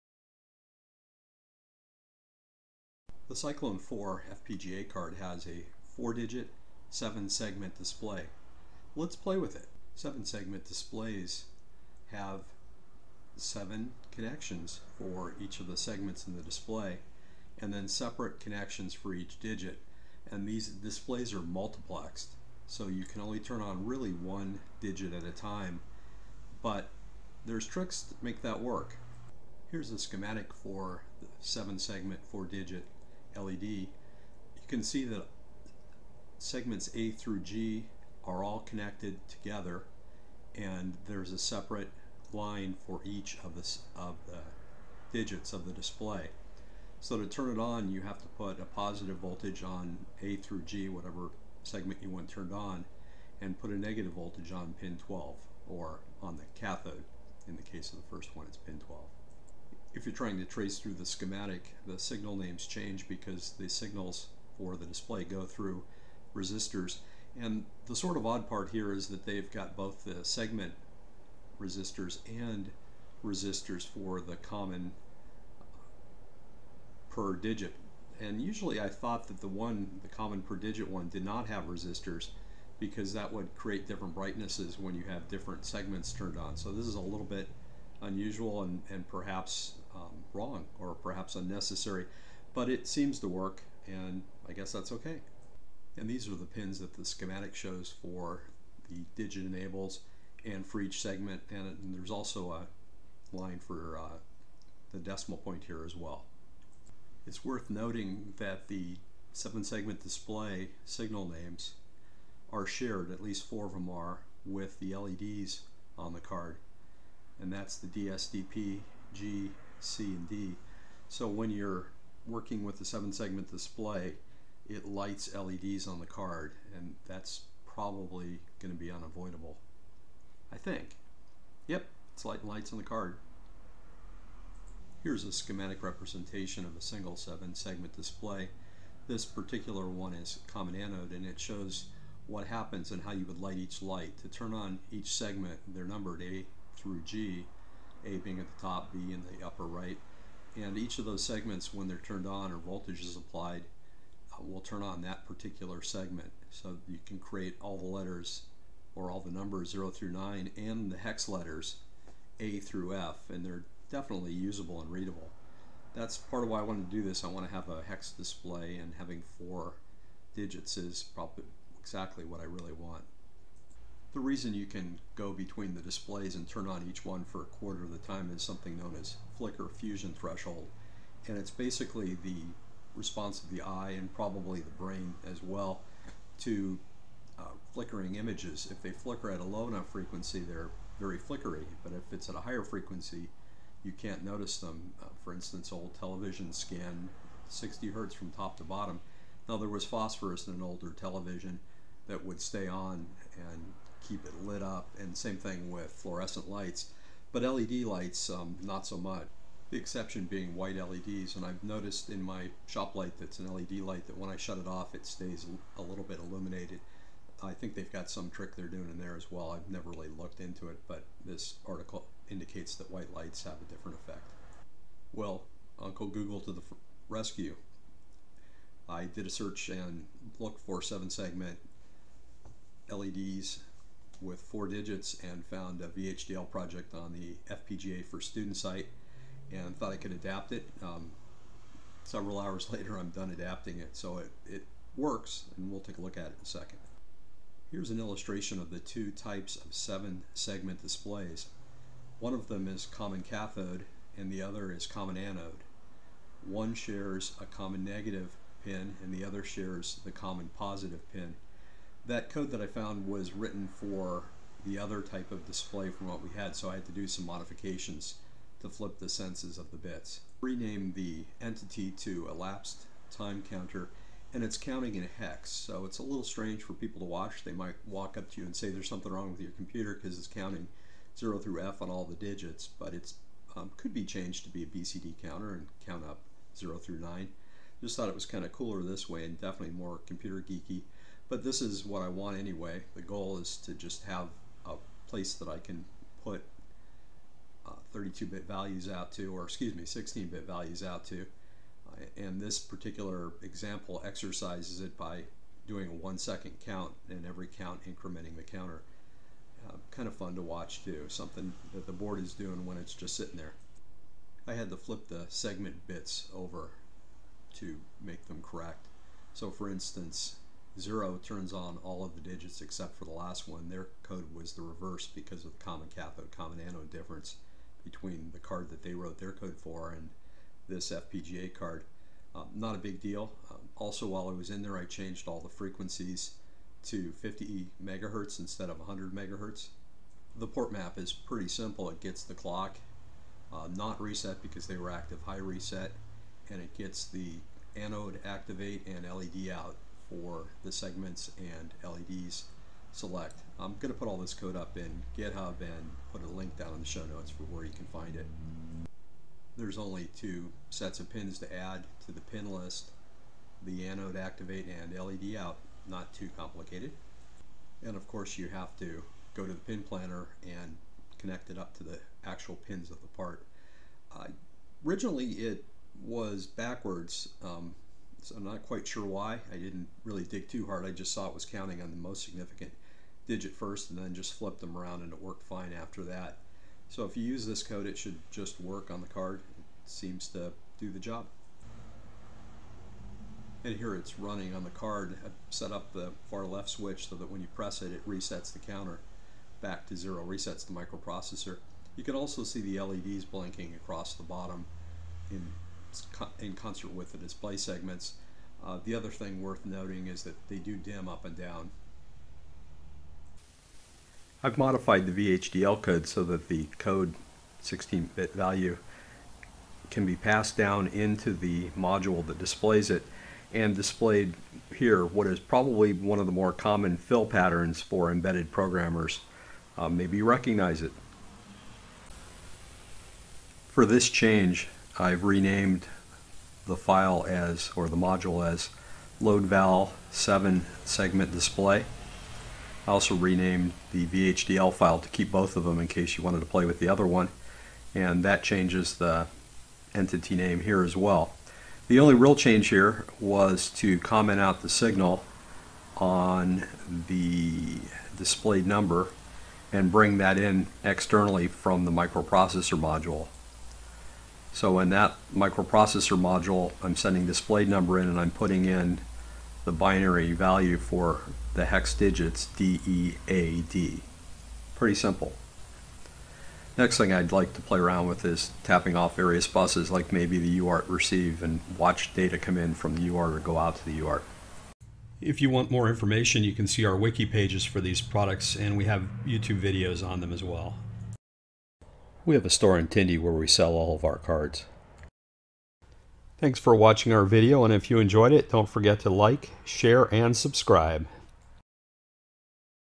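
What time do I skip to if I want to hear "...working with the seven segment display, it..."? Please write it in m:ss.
2:02.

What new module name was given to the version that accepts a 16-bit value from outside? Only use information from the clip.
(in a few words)
loadval 7 segment display.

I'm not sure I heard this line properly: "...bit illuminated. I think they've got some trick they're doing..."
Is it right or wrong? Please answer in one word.
right.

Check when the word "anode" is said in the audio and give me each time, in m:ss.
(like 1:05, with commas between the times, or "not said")
2:20, 4:15, 5:26, 5:47, 6:03.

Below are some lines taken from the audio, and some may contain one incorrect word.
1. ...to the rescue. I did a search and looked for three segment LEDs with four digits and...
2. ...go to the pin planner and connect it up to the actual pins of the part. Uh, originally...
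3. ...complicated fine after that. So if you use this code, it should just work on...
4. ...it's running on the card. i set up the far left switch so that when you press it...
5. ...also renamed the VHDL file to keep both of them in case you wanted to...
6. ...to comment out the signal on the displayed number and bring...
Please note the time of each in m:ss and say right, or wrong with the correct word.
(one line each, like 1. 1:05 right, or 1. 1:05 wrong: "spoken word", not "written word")
1. 3:46 wrong: "seven", not "three"
2. 6:09 right
3. 6:25 wrong: "worked", not "complicated"
4. 6:33 right
5. 7:22 right
6. 7:33 right.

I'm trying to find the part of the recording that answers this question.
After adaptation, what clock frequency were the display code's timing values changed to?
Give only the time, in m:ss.
5:37.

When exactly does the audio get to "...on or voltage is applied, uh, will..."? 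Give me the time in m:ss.
2:32.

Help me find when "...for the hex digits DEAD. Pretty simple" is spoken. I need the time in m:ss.
7:50.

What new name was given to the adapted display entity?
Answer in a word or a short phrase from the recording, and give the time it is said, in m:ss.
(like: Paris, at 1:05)
elapsed time counter, at 4:32.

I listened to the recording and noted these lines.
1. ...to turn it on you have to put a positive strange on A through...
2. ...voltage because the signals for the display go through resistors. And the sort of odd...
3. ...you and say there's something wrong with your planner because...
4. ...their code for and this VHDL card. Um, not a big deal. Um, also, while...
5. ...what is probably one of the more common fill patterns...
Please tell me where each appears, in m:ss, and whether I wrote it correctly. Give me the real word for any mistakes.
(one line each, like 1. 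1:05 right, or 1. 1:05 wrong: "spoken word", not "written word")
1. 0:47 wrong: "voltage", not "strange"
2. 1:02 wrong: "change", not "voltage"
3. 4:38 wrong: "computer", not "planner"
4. 5:29 wrong: "FPGA", not "VHDL"
5. 7:05 right.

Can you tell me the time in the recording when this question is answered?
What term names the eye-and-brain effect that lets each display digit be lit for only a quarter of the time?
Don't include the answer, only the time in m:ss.
2:59.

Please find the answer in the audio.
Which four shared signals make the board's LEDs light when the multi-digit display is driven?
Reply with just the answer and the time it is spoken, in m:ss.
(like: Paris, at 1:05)
DSDP, G, C, and D, at 1:57.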